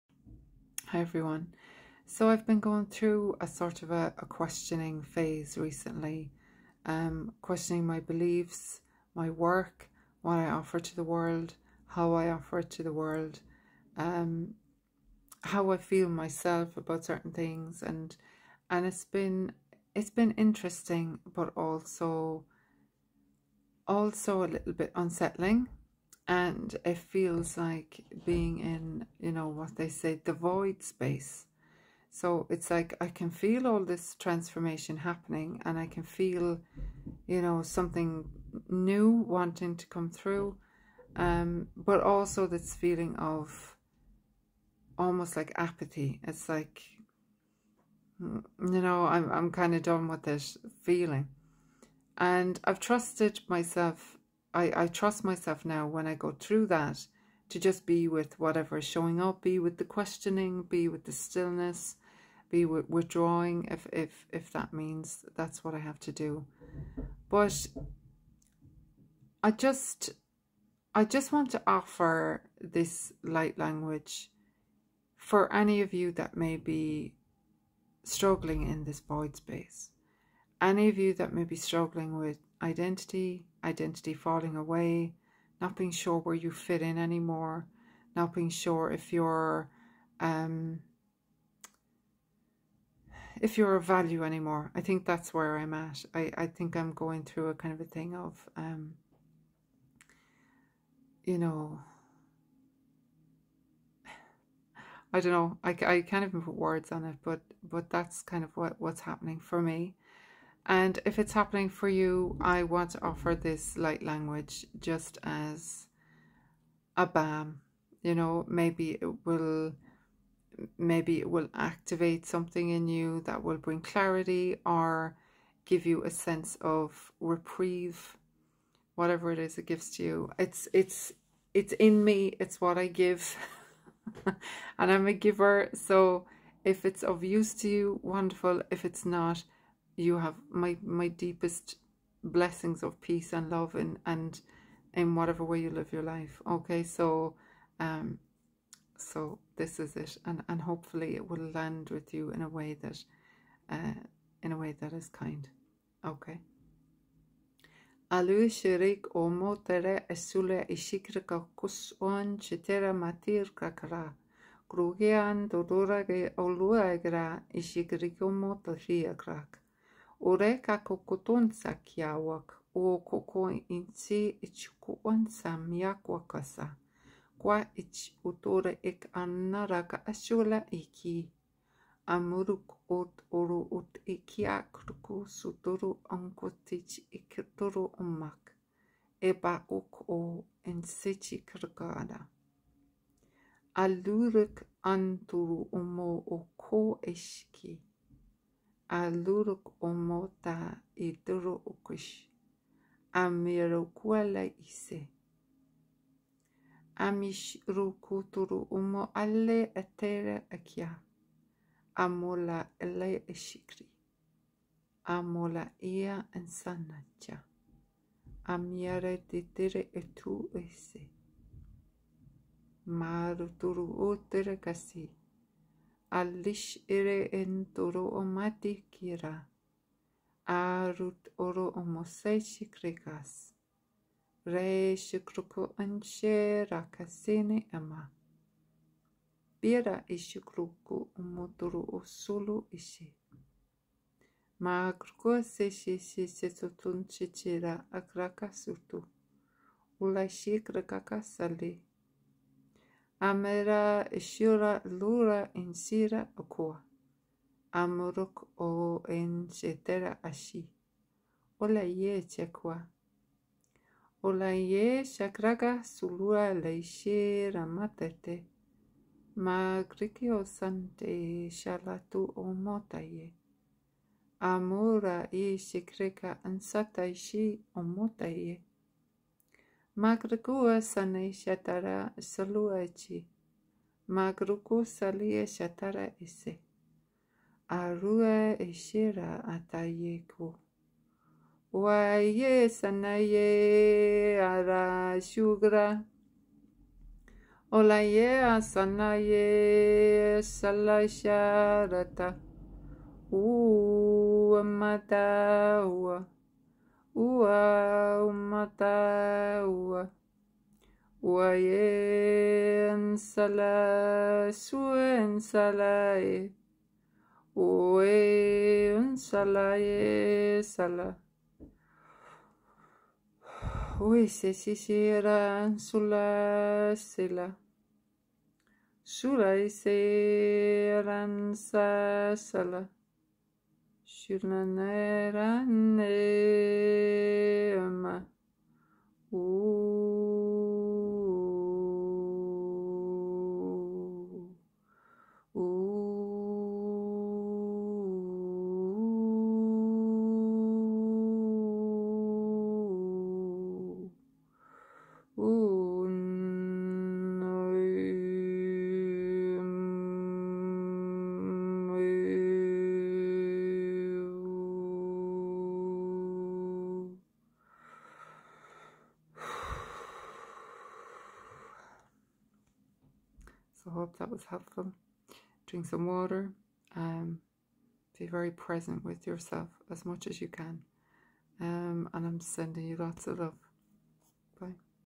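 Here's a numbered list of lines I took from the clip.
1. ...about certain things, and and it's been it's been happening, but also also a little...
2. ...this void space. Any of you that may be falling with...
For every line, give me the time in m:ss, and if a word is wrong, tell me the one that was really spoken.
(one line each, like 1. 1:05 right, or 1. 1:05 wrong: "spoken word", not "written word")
1. 0:16 wrong: "interesting", not "happening"
2. 1:18 wrong: "struggling", not "falling".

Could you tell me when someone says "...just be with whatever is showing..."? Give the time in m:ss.
0:57.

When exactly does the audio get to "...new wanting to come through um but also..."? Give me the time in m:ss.
0:38.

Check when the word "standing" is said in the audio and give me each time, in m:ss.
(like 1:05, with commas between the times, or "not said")
not said.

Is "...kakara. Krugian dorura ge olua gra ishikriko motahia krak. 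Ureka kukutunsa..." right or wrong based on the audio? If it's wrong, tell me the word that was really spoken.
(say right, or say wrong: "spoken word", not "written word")
right.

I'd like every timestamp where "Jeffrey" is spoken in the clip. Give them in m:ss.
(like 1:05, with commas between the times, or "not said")
not said.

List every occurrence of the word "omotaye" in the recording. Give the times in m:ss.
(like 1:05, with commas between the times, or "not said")
4:32, 4:37.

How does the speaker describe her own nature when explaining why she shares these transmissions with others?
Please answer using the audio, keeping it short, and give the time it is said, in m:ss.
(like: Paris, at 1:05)
a giver, at 2:15.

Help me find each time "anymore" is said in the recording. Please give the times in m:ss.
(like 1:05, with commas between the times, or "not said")
1:26, 1:34.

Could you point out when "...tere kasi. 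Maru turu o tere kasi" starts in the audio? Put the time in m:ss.
3:44.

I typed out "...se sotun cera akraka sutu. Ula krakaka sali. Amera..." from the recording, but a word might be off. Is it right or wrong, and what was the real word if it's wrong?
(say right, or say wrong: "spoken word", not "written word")
right.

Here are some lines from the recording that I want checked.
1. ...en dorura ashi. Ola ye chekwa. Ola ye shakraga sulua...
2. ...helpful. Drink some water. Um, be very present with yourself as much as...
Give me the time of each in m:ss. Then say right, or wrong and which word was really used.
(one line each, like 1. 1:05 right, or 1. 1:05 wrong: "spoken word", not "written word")
1. 4:19 wrong: "shetera", not "dorura"
2. 6:14 right.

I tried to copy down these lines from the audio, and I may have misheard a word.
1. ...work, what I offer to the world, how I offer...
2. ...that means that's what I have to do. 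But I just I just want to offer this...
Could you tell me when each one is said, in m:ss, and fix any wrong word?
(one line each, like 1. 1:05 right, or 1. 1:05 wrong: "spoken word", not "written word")
1. 0:09 right
2. 1:04 right.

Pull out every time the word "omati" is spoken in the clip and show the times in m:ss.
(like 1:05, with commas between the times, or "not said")
3:48.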